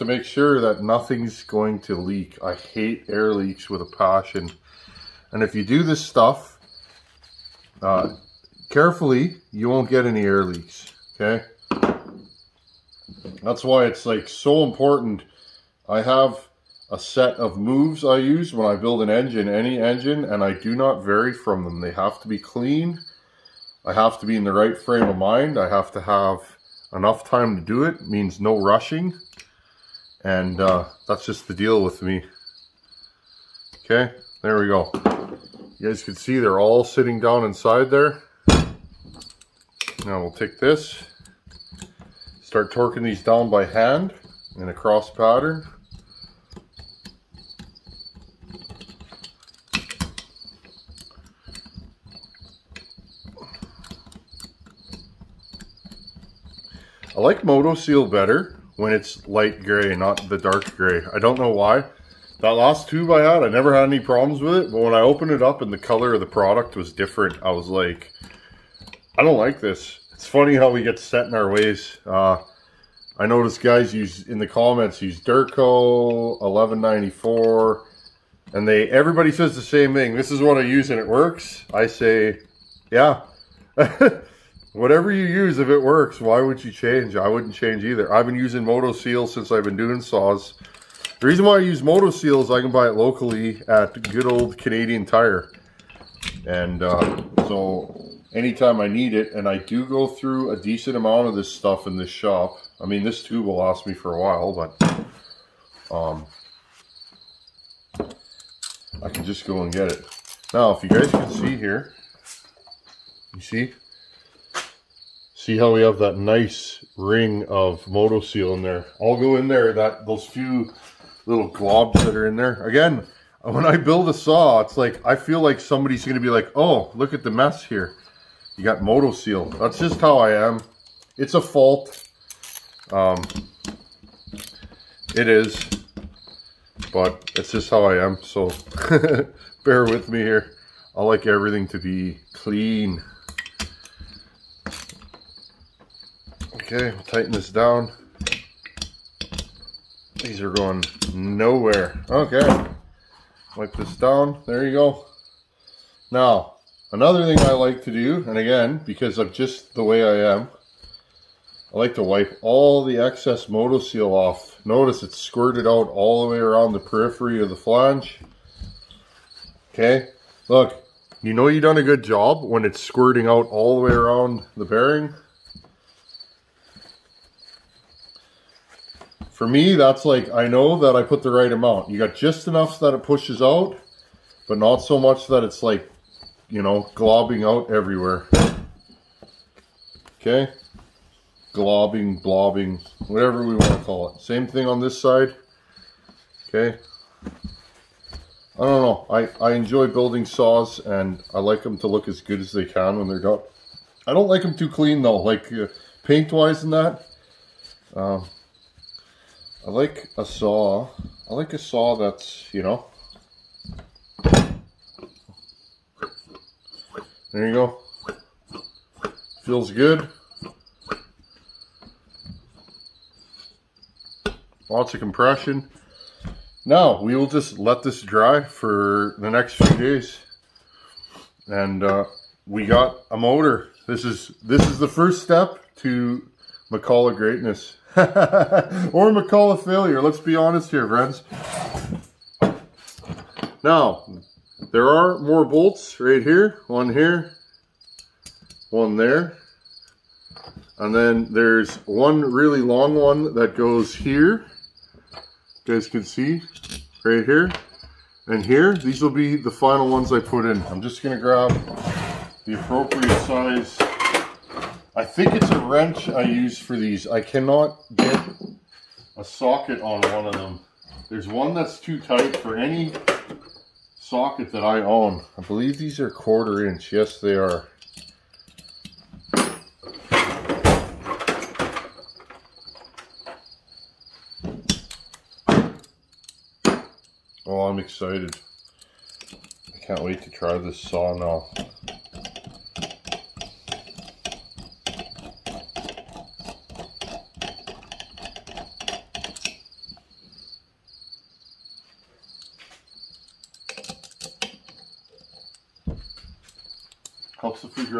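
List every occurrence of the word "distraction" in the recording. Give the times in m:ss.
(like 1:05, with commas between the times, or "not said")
not said.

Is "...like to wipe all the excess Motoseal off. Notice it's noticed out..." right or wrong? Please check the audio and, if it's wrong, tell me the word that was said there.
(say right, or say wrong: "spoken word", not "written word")
wrong: "squirted", not "noticed".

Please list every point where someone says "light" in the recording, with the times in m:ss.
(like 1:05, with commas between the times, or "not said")
0:59.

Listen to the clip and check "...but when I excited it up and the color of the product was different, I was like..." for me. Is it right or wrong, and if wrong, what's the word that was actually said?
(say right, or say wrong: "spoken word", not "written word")
wrong: "opened", not "excited".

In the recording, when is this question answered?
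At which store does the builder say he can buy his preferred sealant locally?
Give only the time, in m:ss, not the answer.
1:34.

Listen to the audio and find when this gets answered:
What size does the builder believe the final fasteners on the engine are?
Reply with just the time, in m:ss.
4:36.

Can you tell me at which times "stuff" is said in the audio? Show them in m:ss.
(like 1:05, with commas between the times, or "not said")
0:06, 1:41.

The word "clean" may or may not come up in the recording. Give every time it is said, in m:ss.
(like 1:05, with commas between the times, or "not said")
0:22, 2:22, 3:24.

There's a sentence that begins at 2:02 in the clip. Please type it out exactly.
Again, when I build a saw, it's like, I feel like somebody's going to be like, oh, look at the mess here.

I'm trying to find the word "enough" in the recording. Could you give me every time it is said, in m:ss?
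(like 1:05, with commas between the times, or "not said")
0:26, 3:02.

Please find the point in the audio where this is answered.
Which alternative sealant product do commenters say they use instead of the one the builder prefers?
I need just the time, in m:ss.
1:15.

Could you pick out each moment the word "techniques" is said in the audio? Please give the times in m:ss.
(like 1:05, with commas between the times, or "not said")
not said.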